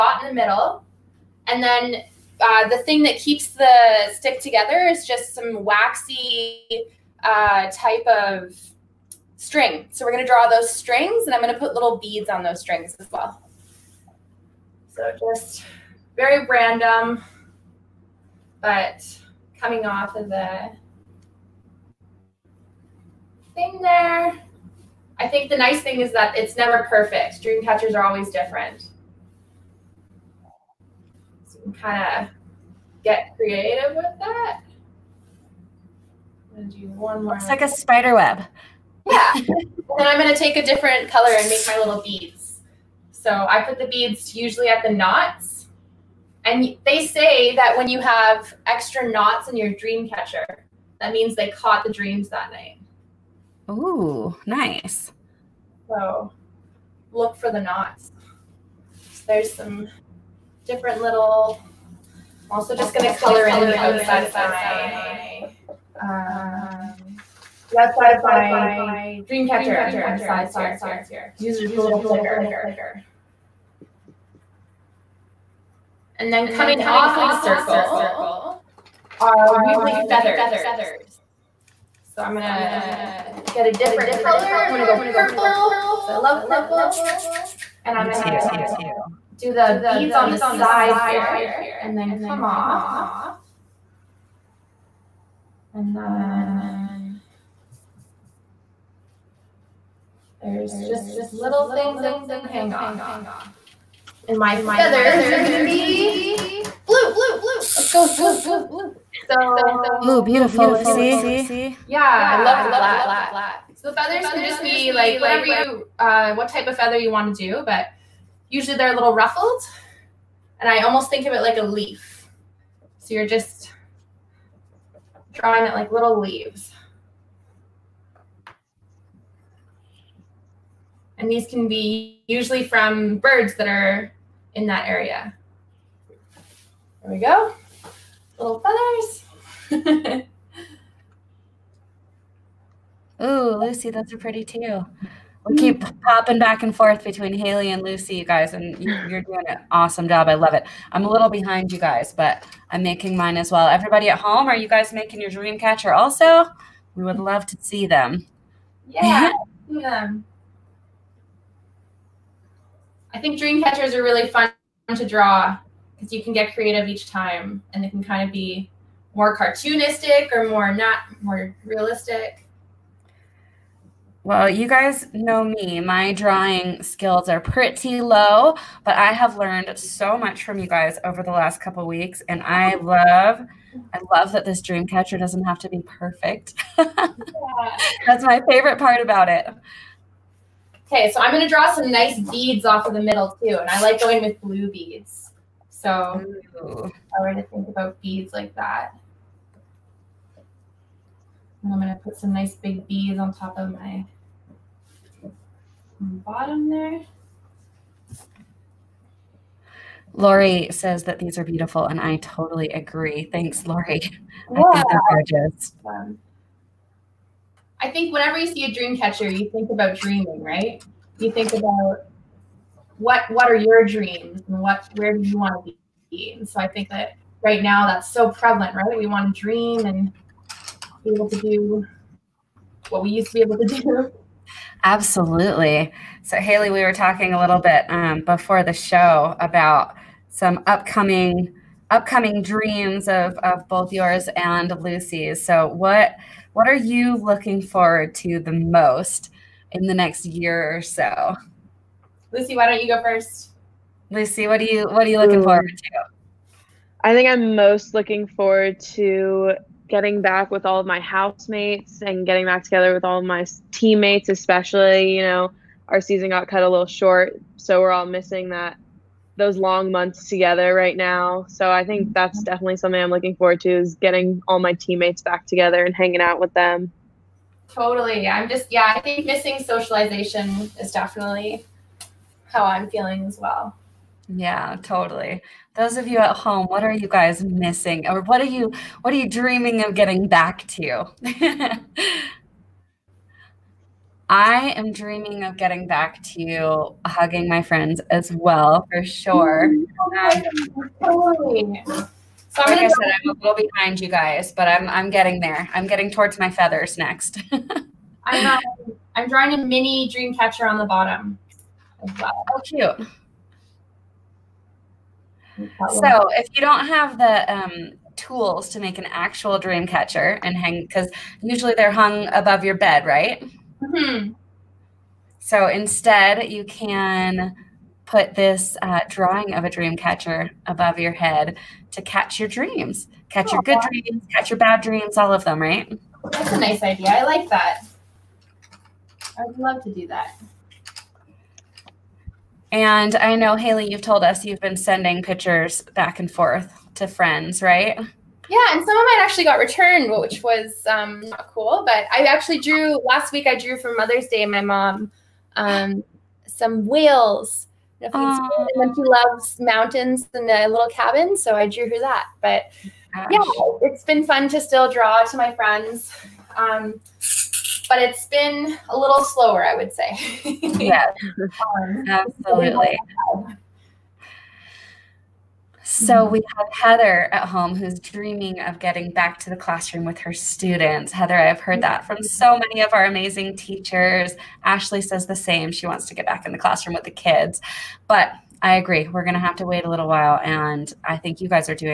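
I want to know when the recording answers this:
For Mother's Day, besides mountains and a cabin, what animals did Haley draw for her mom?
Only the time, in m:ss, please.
5:56.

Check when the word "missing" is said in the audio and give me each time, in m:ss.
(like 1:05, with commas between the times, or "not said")
4:28, 4:39, 4:47.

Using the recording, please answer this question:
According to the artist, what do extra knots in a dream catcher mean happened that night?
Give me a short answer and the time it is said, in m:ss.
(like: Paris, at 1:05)
caught the dreams, at 0:51.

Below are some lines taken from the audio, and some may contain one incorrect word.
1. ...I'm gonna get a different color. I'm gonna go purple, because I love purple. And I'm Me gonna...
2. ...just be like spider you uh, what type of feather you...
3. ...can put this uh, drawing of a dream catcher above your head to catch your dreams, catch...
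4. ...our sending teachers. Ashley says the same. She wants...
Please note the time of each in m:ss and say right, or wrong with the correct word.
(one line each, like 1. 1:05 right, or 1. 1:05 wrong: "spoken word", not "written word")
1. 1:22 right
2. 1:54 wrong: "whatever", not "spider"
3. 5:26 right
4. 6:22 wrong: "amazing", not "sending".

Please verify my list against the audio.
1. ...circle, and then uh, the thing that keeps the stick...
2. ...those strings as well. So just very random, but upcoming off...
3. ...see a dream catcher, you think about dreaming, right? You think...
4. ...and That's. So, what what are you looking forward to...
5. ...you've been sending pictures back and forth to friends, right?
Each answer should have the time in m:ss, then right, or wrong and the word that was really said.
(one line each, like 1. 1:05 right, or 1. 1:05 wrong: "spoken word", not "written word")
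1. 0:00 wrong: "middle", not "circle"
2. 0:12 wrong: "coming", not "upcoming"
3. 3:38 right
4. 4:04 wrong: "Lucy", not "That"
5. 5:44 right.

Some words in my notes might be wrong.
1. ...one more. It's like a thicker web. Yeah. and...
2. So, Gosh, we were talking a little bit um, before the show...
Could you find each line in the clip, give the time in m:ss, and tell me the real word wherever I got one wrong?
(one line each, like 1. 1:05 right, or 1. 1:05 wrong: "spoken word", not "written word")
1. 0:36 wrong: "spider", not "thicker"
2. 3:56 wrong: "Haley", not "Gosh".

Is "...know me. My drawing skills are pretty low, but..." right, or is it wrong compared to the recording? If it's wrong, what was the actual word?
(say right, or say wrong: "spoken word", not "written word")
right.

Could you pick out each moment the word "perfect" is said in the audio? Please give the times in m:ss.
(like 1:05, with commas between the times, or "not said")
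0:26, 3:05.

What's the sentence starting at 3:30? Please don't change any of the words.
Lori says that these are beautiful, and I totally agree.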